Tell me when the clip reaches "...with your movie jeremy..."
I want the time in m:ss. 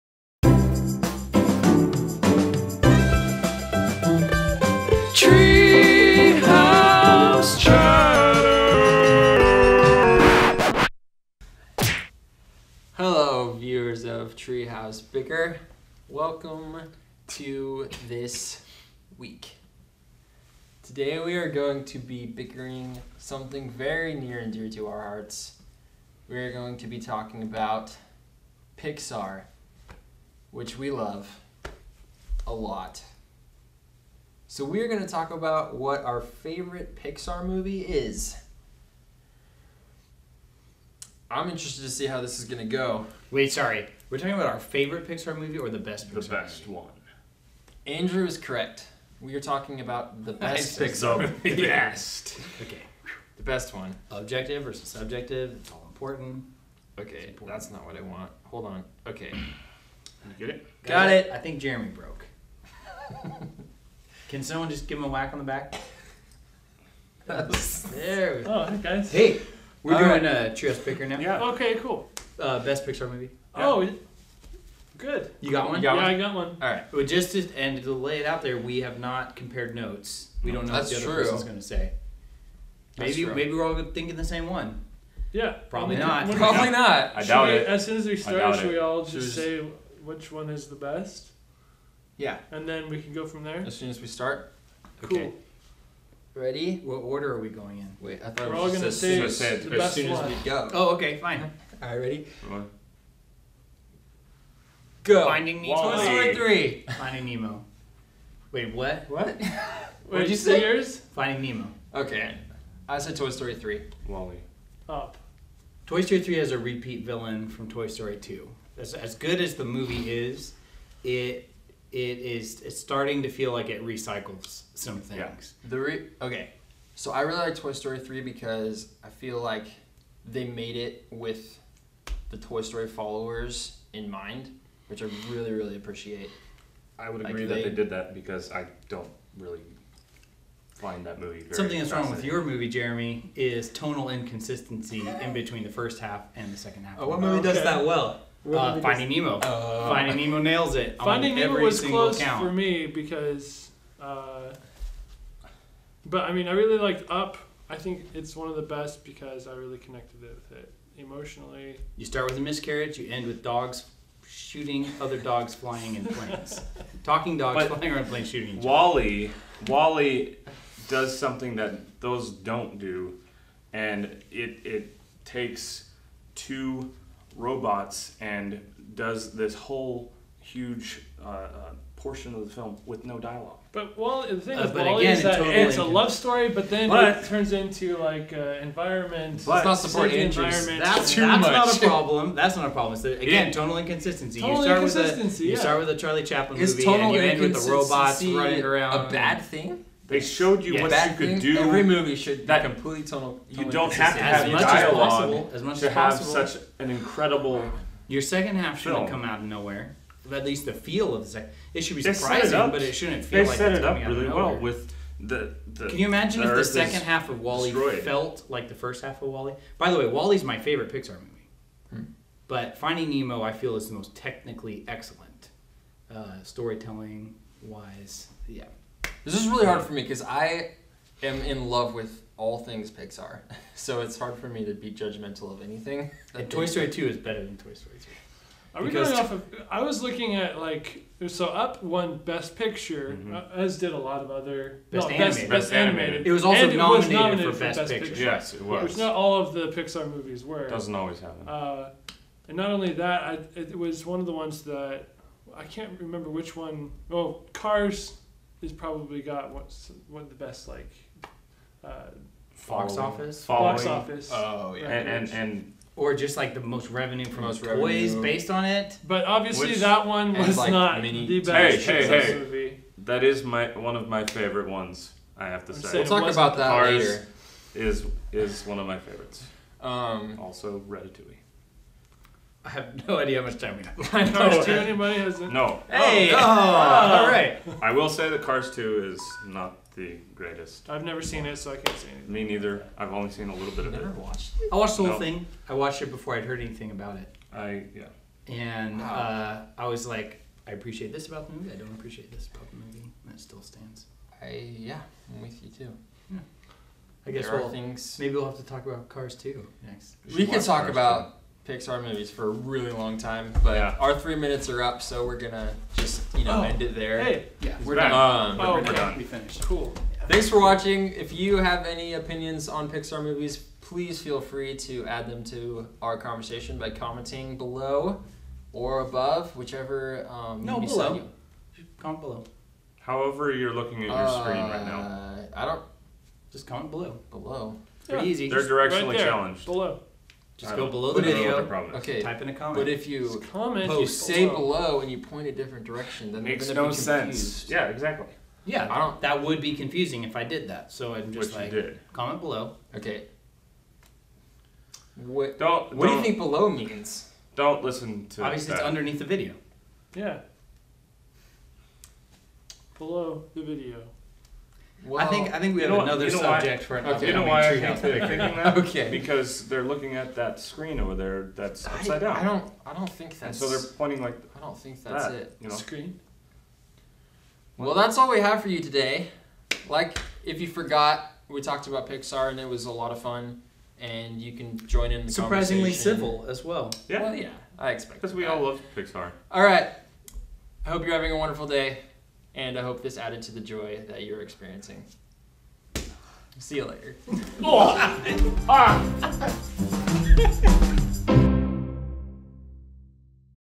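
2:22.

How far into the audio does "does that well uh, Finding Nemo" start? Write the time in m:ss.
2:27.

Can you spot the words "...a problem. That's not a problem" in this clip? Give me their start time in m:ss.
3:11.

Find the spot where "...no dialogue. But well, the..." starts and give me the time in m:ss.
3:03.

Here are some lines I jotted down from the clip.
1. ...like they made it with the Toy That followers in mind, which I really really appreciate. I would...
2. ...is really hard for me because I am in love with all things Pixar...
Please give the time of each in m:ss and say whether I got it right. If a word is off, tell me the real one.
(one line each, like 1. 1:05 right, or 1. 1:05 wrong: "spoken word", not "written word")
1. 2:09 wrong: "Story", not "That"
2. 3:49 right.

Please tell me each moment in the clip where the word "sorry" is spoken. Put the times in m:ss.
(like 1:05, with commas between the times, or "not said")
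0:43.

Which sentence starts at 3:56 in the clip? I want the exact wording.
And Toy Story Two is better than Toy Story Three.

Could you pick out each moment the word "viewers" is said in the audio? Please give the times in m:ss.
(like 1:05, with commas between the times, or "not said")
0:13.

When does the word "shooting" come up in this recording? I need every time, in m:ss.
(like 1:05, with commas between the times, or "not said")
2:44, 2:48.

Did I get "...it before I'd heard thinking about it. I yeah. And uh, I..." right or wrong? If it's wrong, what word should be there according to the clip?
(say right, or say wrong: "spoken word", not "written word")
wrong: "anything", not "thinking".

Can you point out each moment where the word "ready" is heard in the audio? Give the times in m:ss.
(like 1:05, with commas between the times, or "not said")
1:36, 1:41.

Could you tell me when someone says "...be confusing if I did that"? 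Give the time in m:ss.
5:49.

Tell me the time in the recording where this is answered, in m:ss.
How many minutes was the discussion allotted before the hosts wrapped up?
5:14.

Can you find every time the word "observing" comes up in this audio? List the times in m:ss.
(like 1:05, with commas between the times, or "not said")
not said.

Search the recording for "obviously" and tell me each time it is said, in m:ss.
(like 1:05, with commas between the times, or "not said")
4:29, 5:58.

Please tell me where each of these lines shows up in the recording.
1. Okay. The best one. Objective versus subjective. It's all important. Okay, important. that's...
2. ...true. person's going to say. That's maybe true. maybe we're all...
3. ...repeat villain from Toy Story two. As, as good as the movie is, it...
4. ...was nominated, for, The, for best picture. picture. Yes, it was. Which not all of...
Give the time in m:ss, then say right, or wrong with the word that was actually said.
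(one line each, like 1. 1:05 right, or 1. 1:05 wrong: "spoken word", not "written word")
1. 0:52 right
2. 1:21 right
3. 1:56 right
4. 4:06 wrong: "Best", not "The".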